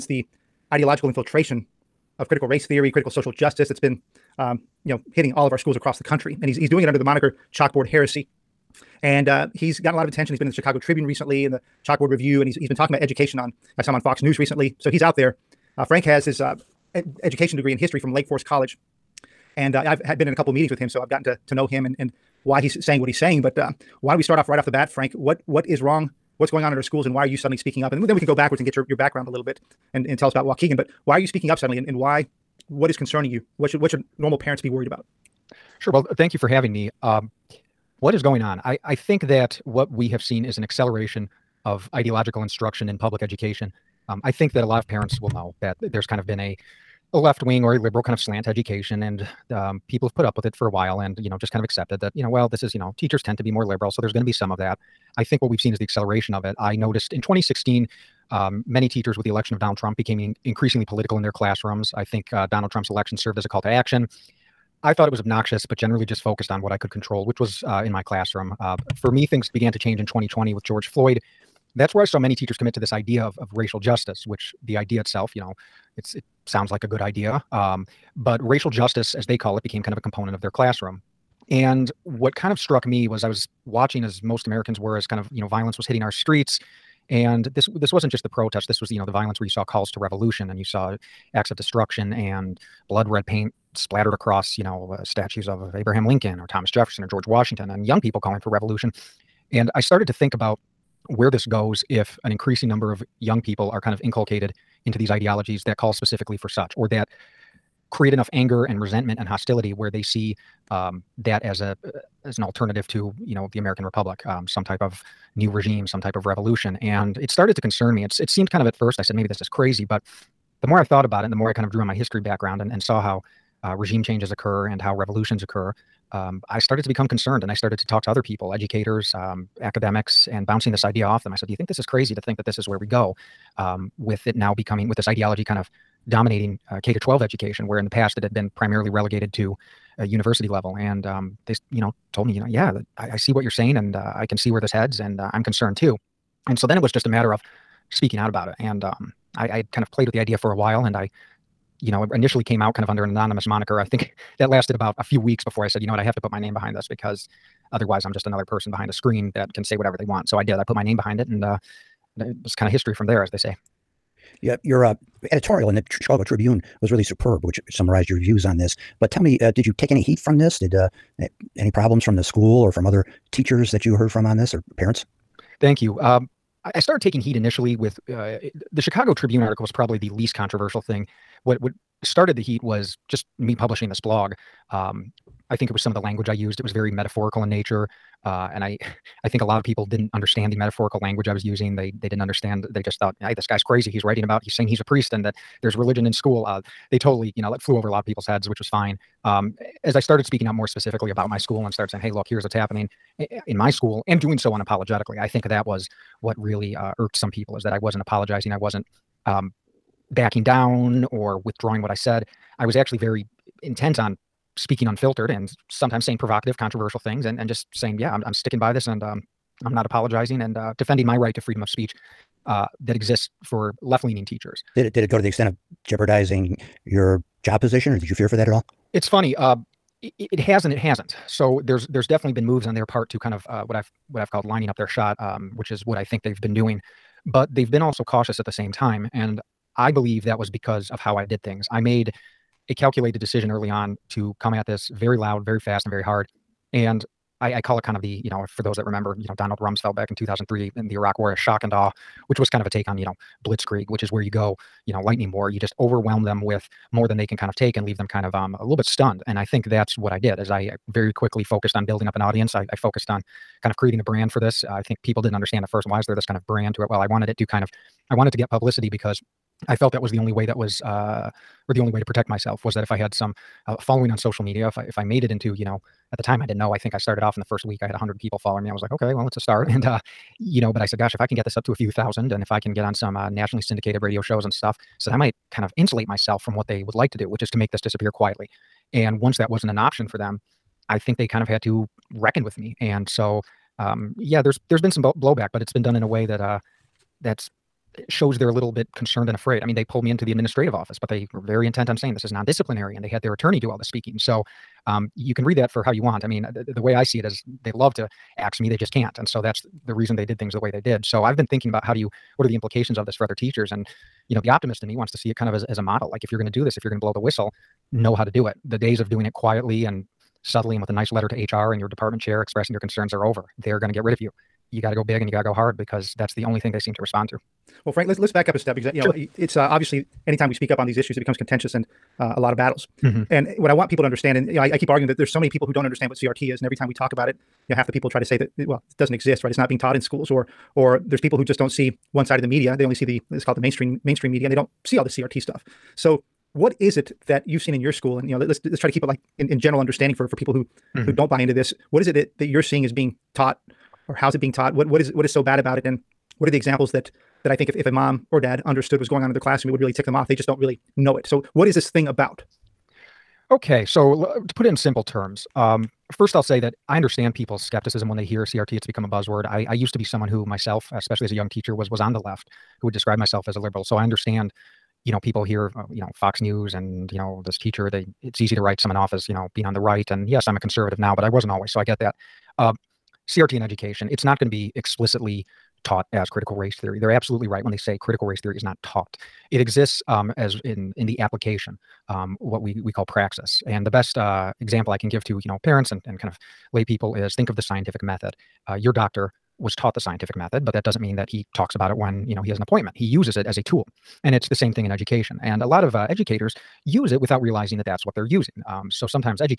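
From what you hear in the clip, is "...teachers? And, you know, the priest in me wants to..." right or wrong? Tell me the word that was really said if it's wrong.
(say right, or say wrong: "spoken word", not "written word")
wrong: "optimist", not "priest".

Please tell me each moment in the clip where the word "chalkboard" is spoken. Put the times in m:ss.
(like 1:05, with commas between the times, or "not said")
0:07, 0:11.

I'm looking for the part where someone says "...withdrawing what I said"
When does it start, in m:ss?
3:31.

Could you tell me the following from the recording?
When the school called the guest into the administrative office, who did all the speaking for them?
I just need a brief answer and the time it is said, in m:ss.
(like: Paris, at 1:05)
their attorney, at 5:03.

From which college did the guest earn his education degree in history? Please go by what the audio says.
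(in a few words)
Lake Forest College.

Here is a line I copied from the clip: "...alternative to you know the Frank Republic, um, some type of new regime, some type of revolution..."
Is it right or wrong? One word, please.
wrong.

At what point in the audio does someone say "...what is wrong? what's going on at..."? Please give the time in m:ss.
0:25.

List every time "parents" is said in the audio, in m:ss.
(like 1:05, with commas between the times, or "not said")
0:34, 0:44, 2:54, 6:35.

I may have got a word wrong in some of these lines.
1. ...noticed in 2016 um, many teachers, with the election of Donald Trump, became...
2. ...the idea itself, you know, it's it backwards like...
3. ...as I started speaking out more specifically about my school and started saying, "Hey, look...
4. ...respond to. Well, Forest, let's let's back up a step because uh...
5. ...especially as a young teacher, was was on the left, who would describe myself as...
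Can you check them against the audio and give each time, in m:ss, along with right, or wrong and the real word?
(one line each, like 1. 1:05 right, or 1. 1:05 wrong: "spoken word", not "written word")
1. 0:56 right
2. 1:14 wrong: "sounds", not "backwards"
3. 3:19 right
4. 5:27 wrong: "Frank", not "Forest"
5. 6:10 right.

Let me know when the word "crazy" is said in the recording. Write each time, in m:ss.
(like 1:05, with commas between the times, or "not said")
1:59, 2:11, 3:13.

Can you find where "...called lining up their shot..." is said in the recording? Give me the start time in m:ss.
3:54.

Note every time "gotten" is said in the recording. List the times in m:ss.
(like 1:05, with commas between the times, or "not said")
0:09, 0:21.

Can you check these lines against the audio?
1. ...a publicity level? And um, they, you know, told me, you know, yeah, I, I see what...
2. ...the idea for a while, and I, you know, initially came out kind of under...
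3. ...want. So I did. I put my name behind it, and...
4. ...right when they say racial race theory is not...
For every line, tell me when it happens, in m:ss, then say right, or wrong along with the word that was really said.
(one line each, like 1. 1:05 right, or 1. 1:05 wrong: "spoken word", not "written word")
1. 2:19 wrong: "university", not "publicity"
2. 2:30 right
3. 2:40 right
4. 6:27 wrong: "critical", not "racial".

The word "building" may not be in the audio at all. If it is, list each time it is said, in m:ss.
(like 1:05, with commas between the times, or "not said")
4:21.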